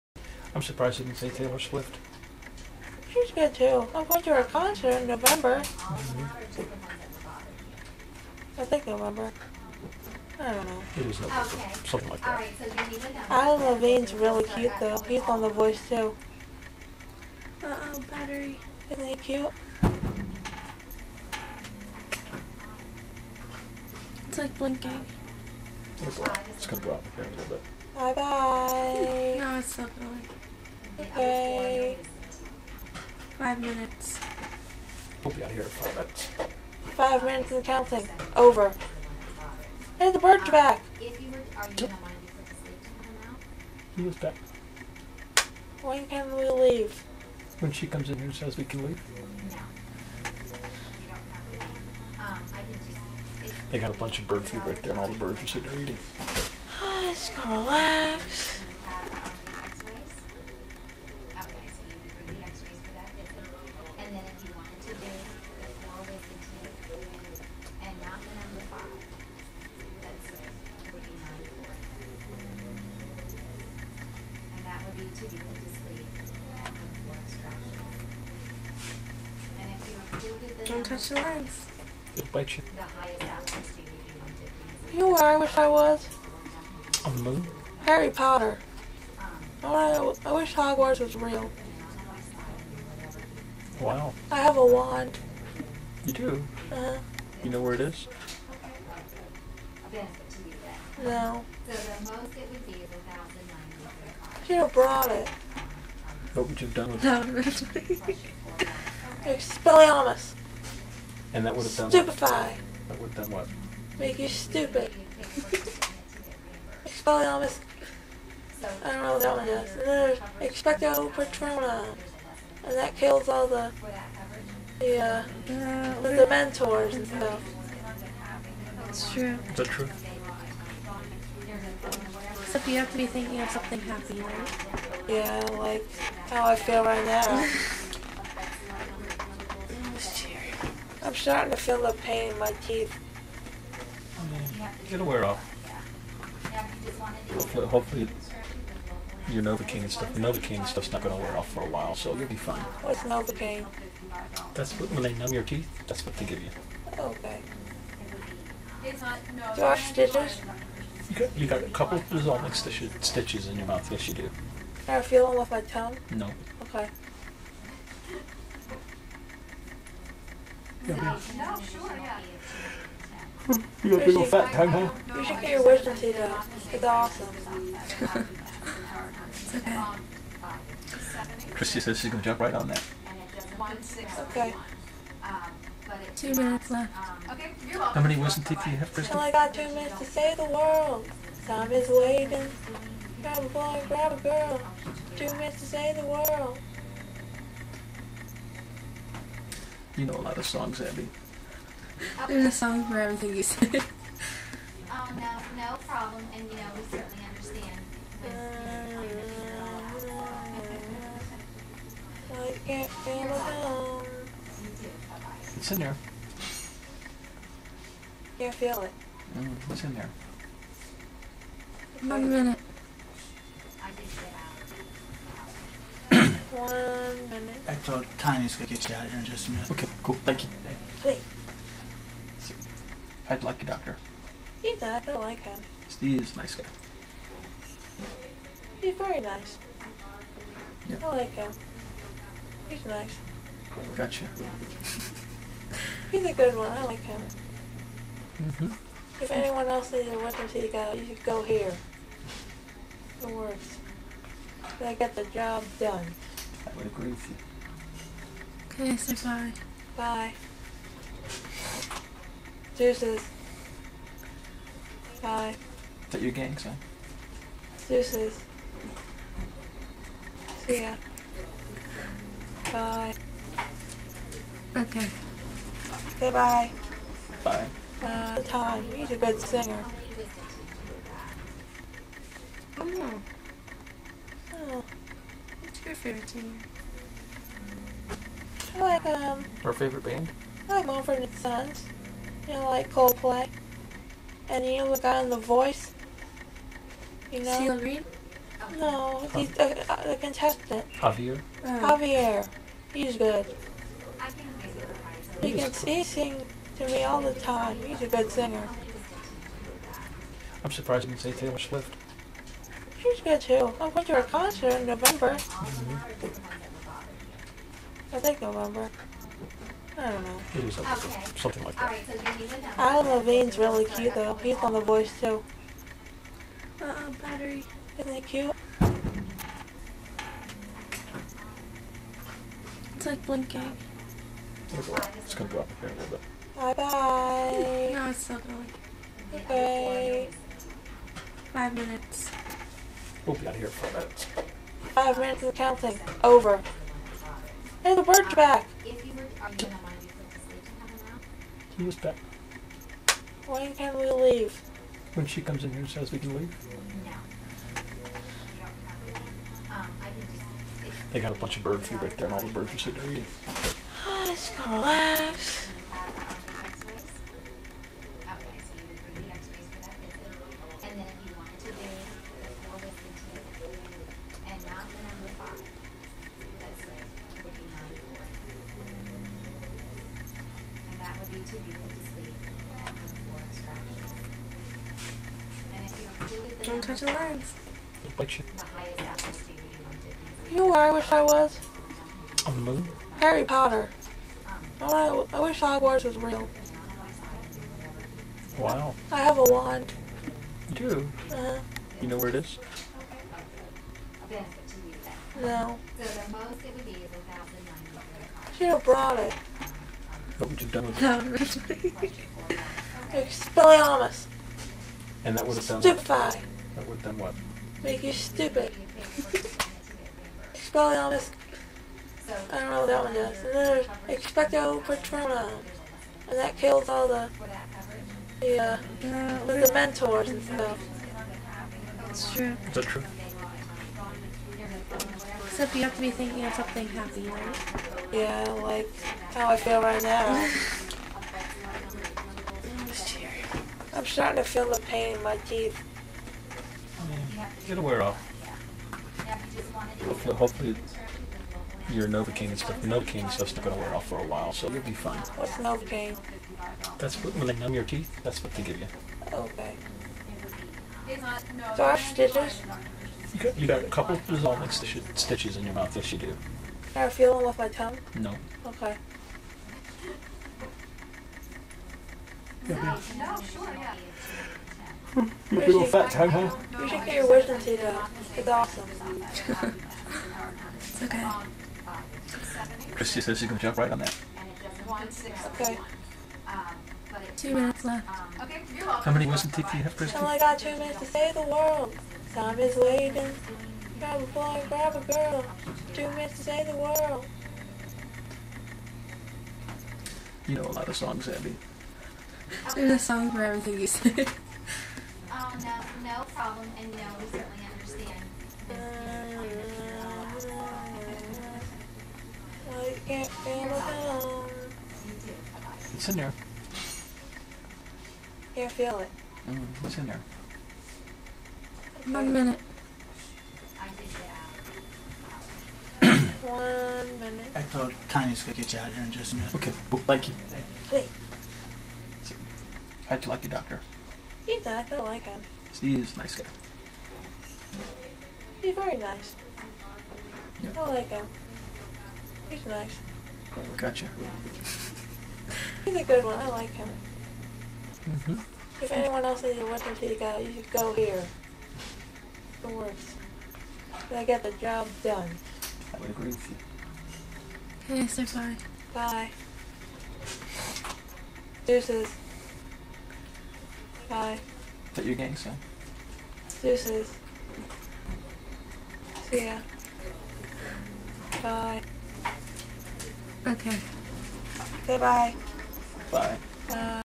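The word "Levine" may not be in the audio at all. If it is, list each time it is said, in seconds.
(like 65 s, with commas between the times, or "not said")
13 s, 323 s.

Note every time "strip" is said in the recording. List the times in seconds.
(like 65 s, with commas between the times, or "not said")
not said.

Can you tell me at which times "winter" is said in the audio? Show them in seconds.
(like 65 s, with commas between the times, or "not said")
250 s, 549 s.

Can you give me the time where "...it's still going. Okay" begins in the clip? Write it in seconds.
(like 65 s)
338 s.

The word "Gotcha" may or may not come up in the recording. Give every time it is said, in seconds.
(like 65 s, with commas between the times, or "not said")
243 s, 543 s.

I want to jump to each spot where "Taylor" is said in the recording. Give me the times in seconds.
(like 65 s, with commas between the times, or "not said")
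1 s, 311 s.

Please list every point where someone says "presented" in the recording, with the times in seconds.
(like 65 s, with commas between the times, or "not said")
not said.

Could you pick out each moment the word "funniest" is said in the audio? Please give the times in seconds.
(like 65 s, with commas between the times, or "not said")
not said.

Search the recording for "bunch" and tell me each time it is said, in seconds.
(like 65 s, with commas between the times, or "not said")
53 s, 361 s.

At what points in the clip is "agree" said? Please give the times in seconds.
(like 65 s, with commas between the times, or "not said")
256 s, 556 s.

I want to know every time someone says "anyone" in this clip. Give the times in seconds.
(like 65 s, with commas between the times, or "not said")
249 s, 548 s.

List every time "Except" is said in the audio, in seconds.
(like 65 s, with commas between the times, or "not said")
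132 s, 435 s.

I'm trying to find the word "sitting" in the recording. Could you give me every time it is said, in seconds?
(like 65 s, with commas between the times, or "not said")
55 s, 362 s.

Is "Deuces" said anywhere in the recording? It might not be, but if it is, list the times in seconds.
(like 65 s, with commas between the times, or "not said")
262 s, 267 s, 561 s, 566 s.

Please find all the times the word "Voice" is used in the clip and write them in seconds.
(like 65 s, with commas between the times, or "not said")
15 s, 295 s, 324 s.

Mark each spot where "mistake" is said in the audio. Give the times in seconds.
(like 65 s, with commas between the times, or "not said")
not said.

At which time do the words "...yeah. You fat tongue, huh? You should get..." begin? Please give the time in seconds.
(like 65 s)
473 s.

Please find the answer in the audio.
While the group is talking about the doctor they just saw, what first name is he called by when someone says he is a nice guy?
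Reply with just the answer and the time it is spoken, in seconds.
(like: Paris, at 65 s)
Steve, at 235 s.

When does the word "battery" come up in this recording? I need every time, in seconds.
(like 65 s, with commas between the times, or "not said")
18 s, 327 s.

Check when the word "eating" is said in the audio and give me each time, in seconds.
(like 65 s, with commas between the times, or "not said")
55 s, 363 s.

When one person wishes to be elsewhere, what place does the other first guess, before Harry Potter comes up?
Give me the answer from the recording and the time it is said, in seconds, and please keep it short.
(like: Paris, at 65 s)
the moon, at 87 s.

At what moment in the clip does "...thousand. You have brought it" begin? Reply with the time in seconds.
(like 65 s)
103 s.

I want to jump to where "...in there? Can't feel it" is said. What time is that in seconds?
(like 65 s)
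215 s.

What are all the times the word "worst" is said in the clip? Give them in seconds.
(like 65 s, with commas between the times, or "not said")
552 s.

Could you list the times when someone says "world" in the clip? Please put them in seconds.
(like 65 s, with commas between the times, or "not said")
190 s, 196 s, 491 s, 496 s.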